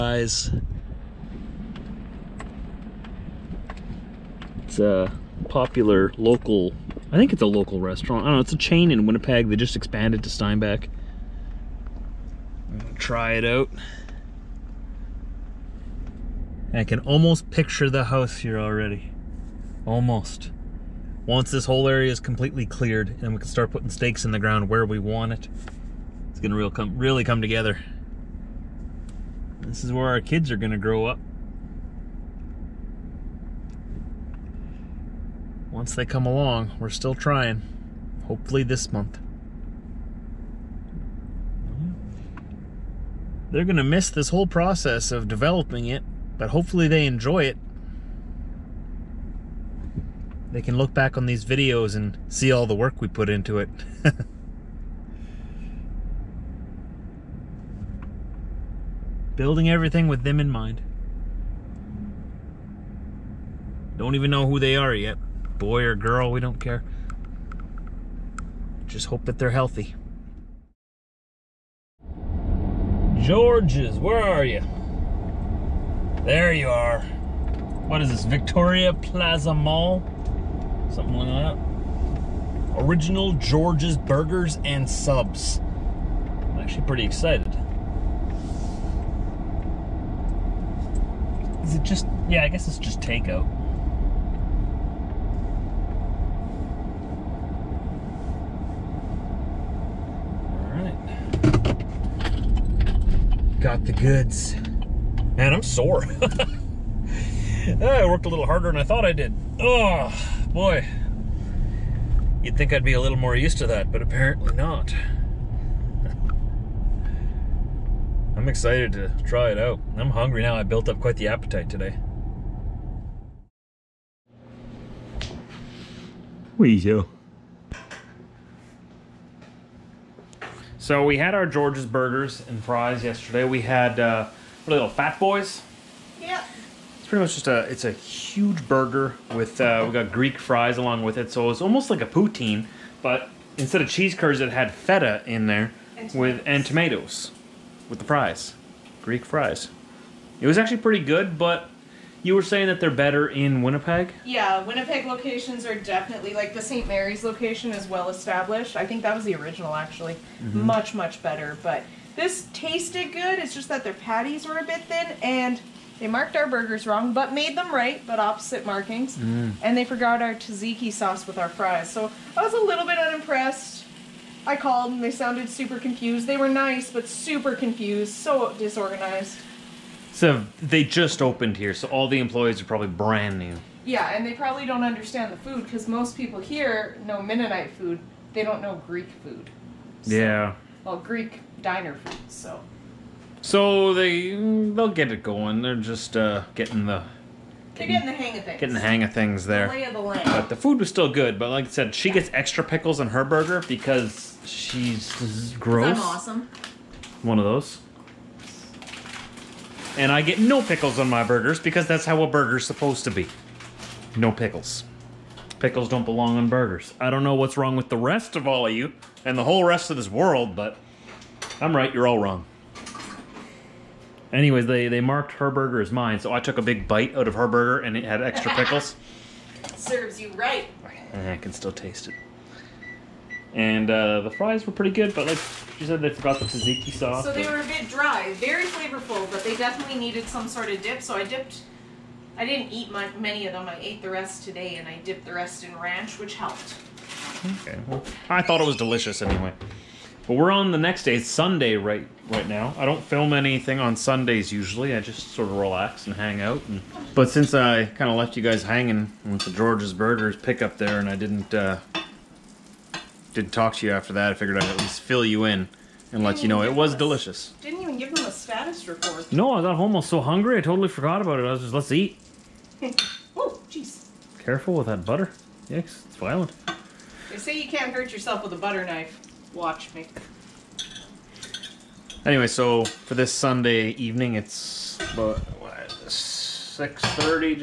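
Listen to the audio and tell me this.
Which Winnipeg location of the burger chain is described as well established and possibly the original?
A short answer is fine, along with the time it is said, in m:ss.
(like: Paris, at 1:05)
St. Mary's, at 2:36.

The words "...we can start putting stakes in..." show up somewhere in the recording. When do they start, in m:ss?
0:23.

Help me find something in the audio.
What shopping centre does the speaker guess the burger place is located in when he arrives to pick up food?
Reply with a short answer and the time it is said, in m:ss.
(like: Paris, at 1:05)
Victoria Plaza Mall, at 1:18.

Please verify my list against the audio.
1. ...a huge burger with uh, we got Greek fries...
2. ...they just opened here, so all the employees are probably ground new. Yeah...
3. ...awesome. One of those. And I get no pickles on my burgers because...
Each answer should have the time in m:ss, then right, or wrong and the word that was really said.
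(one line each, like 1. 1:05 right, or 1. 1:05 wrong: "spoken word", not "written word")
1. 2:17 right
2. 3:00 wrong: "brand", not "ground"
3. 3:26 right.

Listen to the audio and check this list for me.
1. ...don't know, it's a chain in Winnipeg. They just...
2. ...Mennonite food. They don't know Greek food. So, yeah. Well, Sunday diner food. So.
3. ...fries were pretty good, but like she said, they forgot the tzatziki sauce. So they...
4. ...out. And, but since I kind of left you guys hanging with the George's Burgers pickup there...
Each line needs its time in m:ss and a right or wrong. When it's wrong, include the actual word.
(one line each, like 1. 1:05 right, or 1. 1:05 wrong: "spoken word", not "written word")
1. 0:08 right
2. 3:07 wrong: "Greek", not "Sunday"
3. 3:54 right
4. 4:16 right.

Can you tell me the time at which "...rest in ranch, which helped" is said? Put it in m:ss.
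4:05.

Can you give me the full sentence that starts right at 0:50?
They can look back on these videos and see all the work we put into it.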